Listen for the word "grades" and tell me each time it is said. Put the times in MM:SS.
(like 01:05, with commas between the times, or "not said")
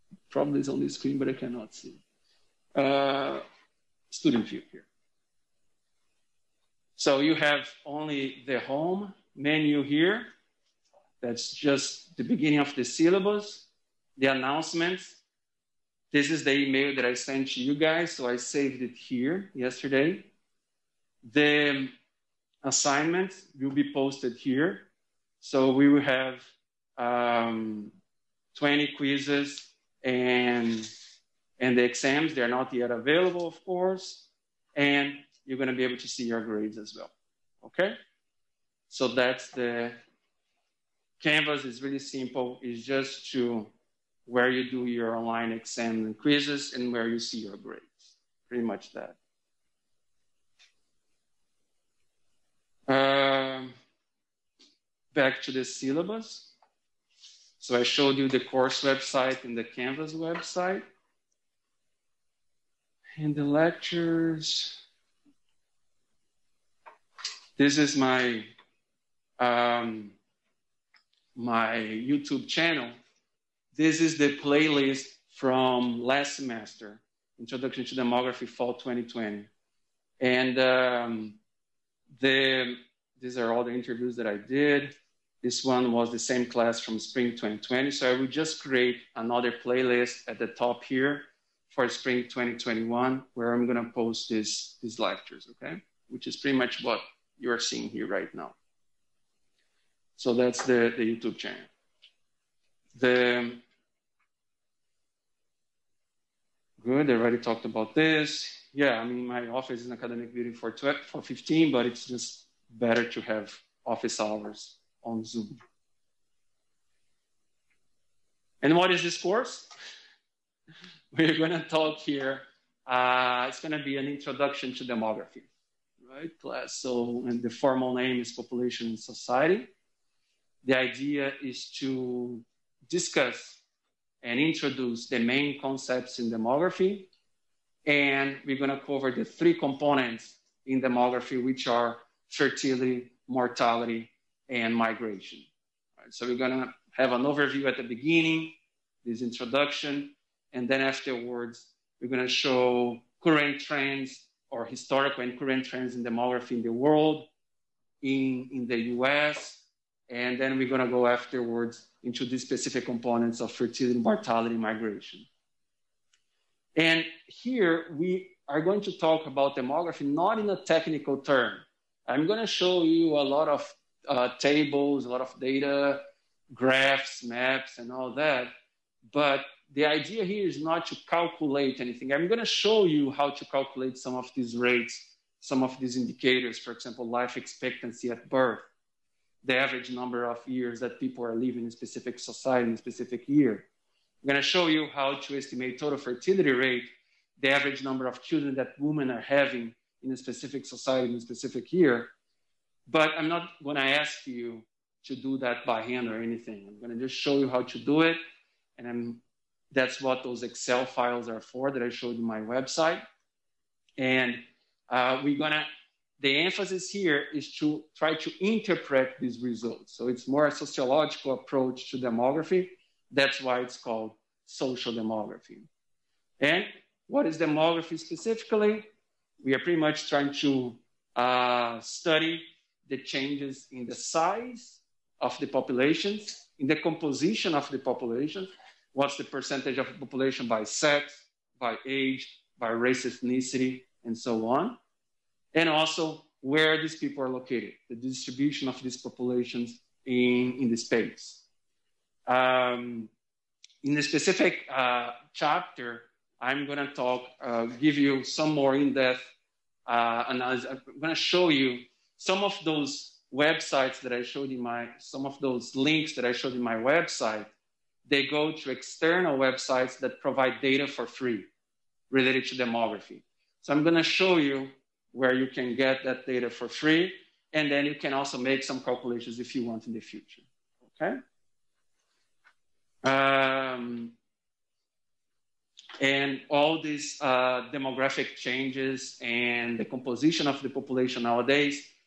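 00:36, 00:47.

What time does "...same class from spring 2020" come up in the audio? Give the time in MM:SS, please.
01:26.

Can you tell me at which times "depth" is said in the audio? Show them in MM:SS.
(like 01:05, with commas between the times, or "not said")
04:18.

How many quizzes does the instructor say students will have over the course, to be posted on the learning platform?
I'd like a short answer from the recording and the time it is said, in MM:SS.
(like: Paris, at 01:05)
20, at 00:28.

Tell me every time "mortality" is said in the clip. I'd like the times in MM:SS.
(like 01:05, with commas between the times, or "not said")
02:23, 02:43.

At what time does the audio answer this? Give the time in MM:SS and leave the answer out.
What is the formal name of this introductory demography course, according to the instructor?
02:08.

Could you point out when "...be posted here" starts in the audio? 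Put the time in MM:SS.
00:23.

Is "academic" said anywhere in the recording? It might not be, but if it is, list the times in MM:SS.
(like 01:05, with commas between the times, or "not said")
01:49.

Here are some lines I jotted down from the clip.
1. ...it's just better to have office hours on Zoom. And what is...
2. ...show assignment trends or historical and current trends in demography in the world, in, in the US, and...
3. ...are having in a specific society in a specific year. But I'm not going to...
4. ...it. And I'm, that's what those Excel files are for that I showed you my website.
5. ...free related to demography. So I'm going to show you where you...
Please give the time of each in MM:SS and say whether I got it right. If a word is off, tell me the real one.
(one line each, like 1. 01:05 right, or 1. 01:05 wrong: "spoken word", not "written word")
1. 01:51 right
2. 02:32 wrong: "current", not "assignment"
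3. 03:19 right
4. 03:28 right
5. 04:31 right.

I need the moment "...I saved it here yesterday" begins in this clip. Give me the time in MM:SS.
00:18.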